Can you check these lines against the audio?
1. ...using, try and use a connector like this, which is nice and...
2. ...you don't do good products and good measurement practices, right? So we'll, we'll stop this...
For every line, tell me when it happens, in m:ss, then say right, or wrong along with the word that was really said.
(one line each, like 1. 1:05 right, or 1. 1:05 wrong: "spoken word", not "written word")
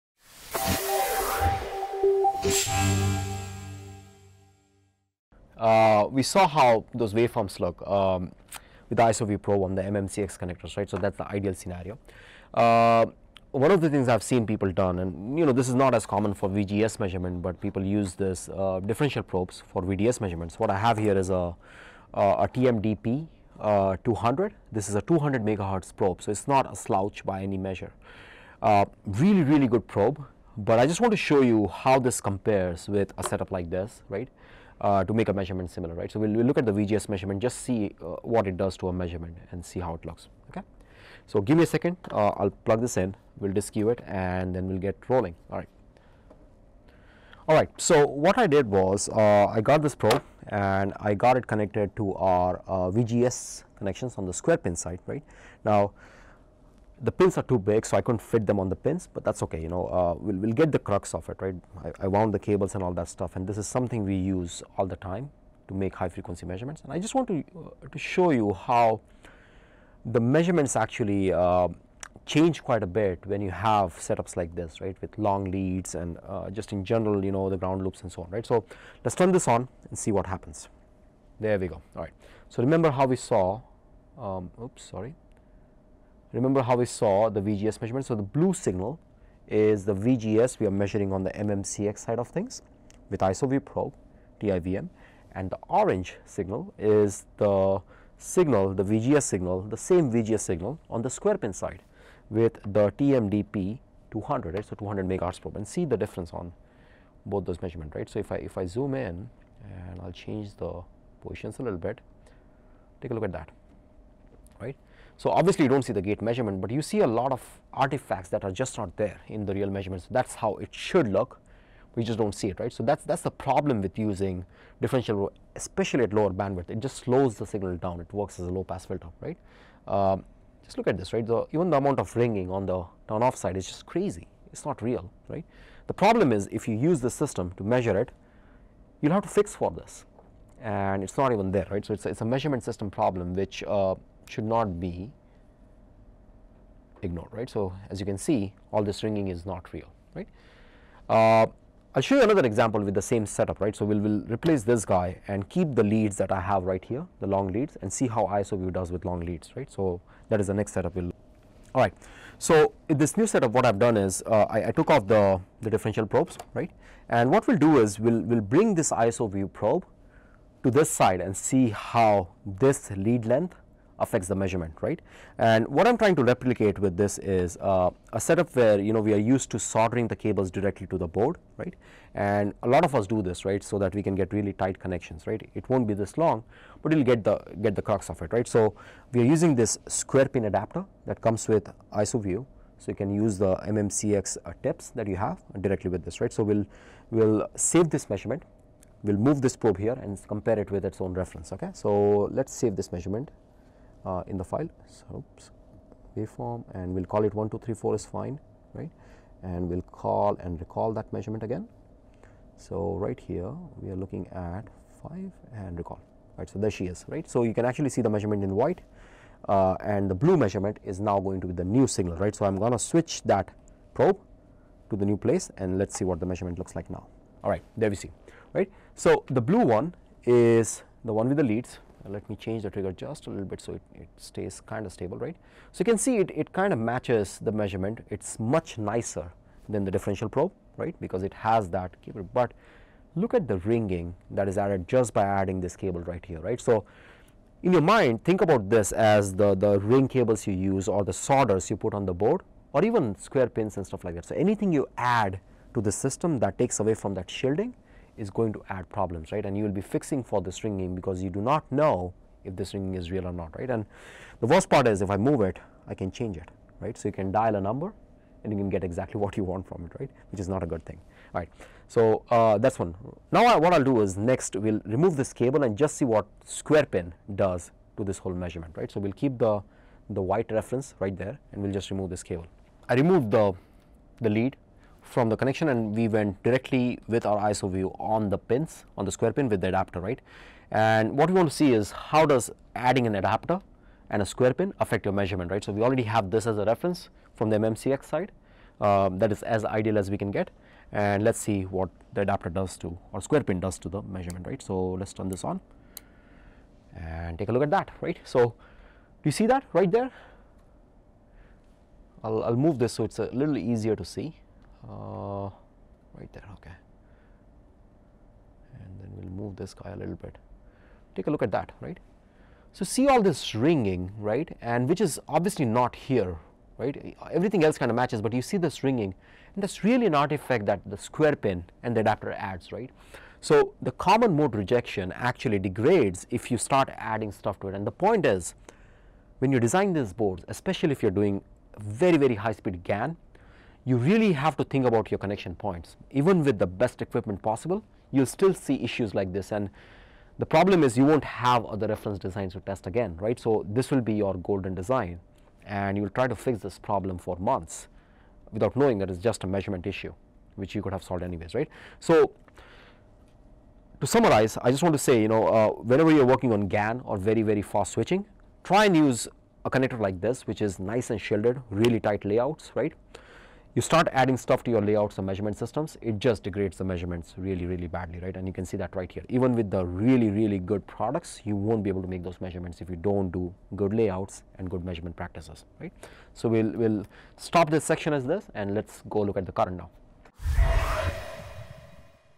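1. 6:07 wrong: "switching", not "using"
2. 6:22 wrong: "layouts", not "products".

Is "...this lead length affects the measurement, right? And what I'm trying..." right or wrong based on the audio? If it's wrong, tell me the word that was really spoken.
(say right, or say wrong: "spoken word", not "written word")
right.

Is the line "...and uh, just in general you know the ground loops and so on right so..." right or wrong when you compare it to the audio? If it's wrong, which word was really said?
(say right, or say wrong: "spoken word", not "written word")
right.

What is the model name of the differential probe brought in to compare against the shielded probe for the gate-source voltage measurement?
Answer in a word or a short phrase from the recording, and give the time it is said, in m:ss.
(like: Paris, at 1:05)
TMDP 200, at 0:22.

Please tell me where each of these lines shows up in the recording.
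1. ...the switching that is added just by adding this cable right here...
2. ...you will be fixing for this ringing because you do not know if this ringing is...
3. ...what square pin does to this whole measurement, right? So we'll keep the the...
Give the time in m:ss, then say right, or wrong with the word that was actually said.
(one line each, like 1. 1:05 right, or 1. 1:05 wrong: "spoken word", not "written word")
1. 4:03 wrong: "ringing", not "switching"
2. 4:19 right
3. 4:36 right.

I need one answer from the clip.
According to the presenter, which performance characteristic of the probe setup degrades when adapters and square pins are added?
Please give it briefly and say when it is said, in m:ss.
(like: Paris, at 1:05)
Common mode rejection, at 5:33.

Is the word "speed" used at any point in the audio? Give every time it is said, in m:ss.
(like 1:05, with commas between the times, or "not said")
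5:42.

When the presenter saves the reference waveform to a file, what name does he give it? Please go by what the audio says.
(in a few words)
1, 2, 3, 4.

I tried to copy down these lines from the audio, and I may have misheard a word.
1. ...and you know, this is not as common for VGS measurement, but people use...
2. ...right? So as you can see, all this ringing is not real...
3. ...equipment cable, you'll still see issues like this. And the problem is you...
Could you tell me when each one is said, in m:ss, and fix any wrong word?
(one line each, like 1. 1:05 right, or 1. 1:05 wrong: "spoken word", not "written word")
1. 0:14 right
2. 2:27 right
3. 5:47 wrong: "possible", not "cable".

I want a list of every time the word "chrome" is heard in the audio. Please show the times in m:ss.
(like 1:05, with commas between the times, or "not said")
not said.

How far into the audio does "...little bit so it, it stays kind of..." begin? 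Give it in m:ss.
3:53.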